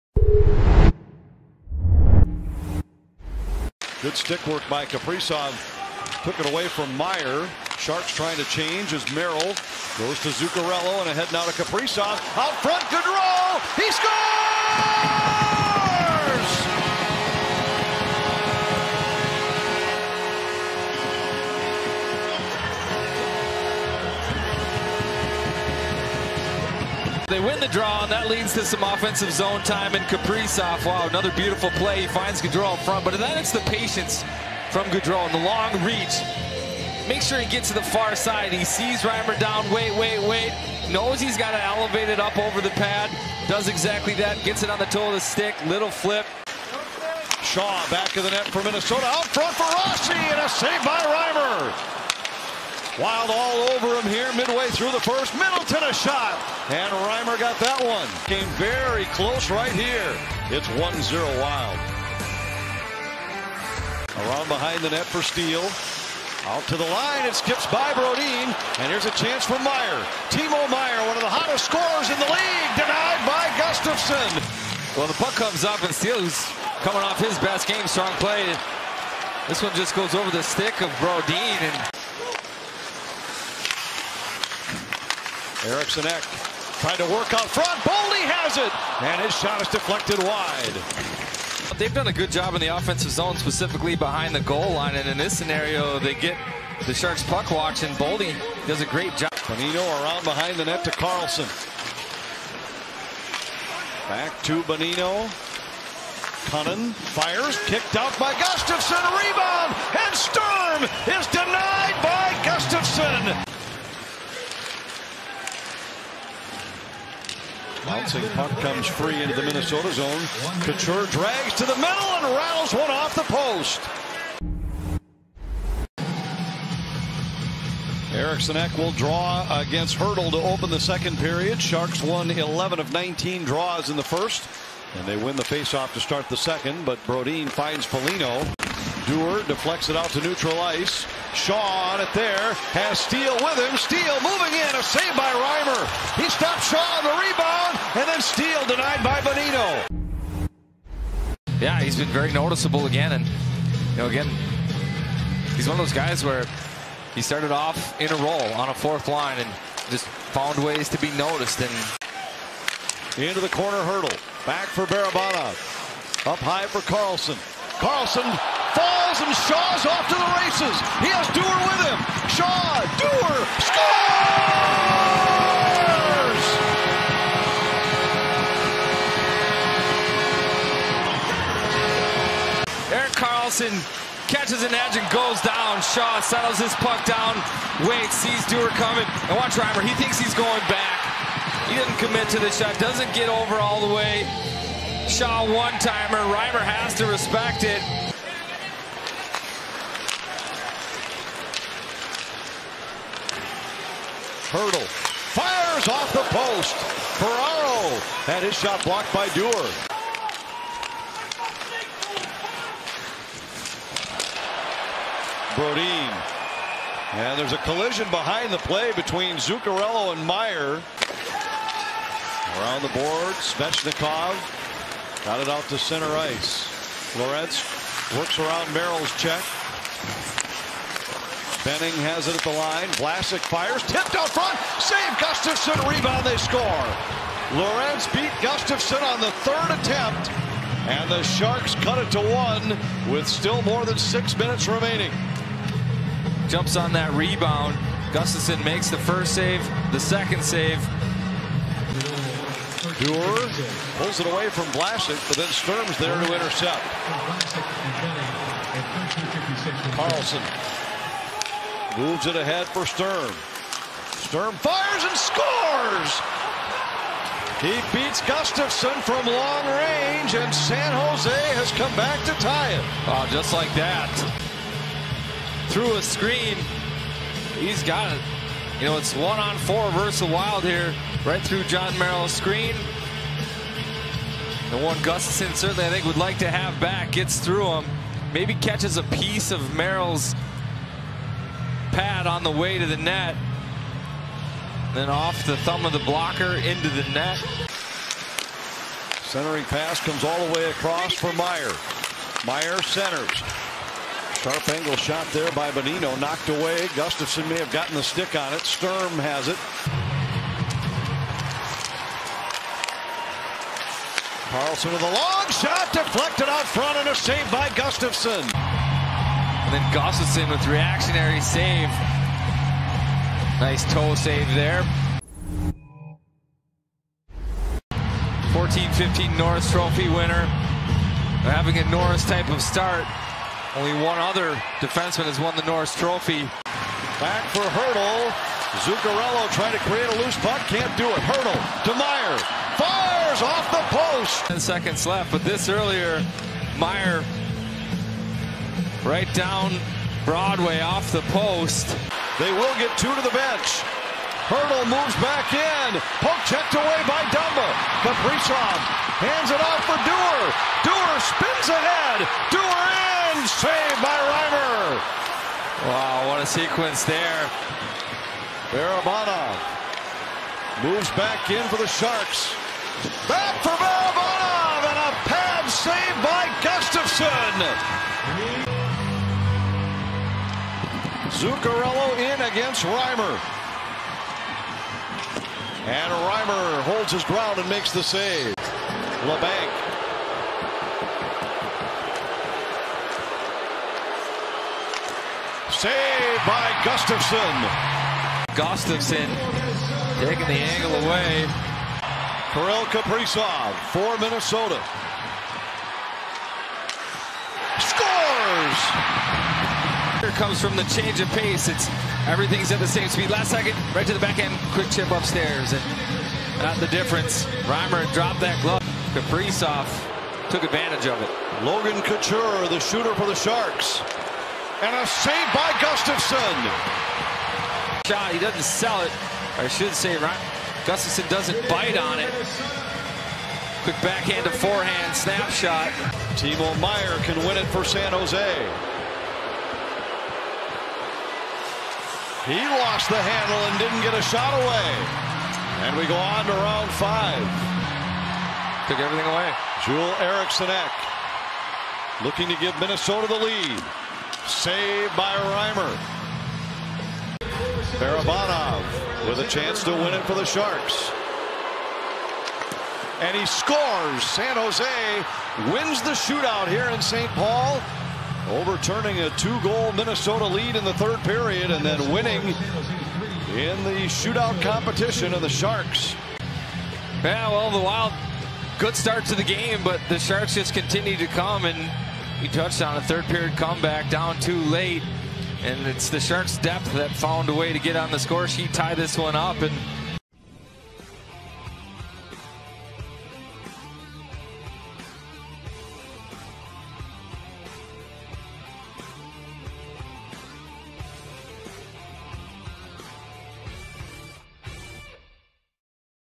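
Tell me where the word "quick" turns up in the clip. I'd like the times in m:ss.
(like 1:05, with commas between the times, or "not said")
6:54, 7:13.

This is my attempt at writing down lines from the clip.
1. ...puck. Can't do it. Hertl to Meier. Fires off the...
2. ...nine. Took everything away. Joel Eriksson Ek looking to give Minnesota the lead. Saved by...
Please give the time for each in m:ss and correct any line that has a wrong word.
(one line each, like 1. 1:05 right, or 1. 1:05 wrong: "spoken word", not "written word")
1. 5:40 right
2. 7:26 wrong: "five", not "nine".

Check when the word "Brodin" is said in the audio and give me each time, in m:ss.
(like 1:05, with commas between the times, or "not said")
1:07, 1:20, 2:17, 3:35.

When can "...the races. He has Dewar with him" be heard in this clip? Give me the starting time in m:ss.
2:50.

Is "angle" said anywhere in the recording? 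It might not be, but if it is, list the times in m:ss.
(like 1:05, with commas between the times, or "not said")
5:04, 6:40.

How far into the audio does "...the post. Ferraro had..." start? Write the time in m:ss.
3:26.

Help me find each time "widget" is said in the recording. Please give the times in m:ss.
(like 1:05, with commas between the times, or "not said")
not said.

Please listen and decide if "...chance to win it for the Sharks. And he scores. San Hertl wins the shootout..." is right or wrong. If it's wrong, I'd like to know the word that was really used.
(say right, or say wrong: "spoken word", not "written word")
wrong: "Jose", not "Hertl".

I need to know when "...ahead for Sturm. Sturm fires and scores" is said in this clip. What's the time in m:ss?
4:22.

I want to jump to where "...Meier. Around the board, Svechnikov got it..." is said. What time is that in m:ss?
3:40.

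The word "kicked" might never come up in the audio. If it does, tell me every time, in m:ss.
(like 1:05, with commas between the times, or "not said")
1:47.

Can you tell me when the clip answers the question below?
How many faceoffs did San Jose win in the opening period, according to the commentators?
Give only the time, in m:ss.
2:12.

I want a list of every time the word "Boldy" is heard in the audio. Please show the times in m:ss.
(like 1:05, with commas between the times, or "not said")
1:27, 1:37.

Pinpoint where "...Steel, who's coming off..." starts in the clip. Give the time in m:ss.
1:15.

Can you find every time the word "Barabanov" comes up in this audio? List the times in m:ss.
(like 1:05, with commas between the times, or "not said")
2:44, 6:08, 6:13, 7:38.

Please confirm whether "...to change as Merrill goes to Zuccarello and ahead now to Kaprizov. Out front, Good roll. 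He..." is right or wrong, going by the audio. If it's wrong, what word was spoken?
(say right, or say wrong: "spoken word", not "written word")
right.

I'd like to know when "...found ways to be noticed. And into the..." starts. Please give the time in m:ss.
2:40.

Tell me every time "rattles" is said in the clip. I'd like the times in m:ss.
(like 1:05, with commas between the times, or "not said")
2:02.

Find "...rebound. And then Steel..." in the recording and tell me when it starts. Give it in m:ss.
2:27.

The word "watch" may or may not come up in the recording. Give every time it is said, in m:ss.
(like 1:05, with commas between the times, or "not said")
1:37, 3:09.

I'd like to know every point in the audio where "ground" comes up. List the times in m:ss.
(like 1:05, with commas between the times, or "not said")
6:27.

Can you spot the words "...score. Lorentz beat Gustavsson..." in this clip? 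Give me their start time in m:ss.
3:56.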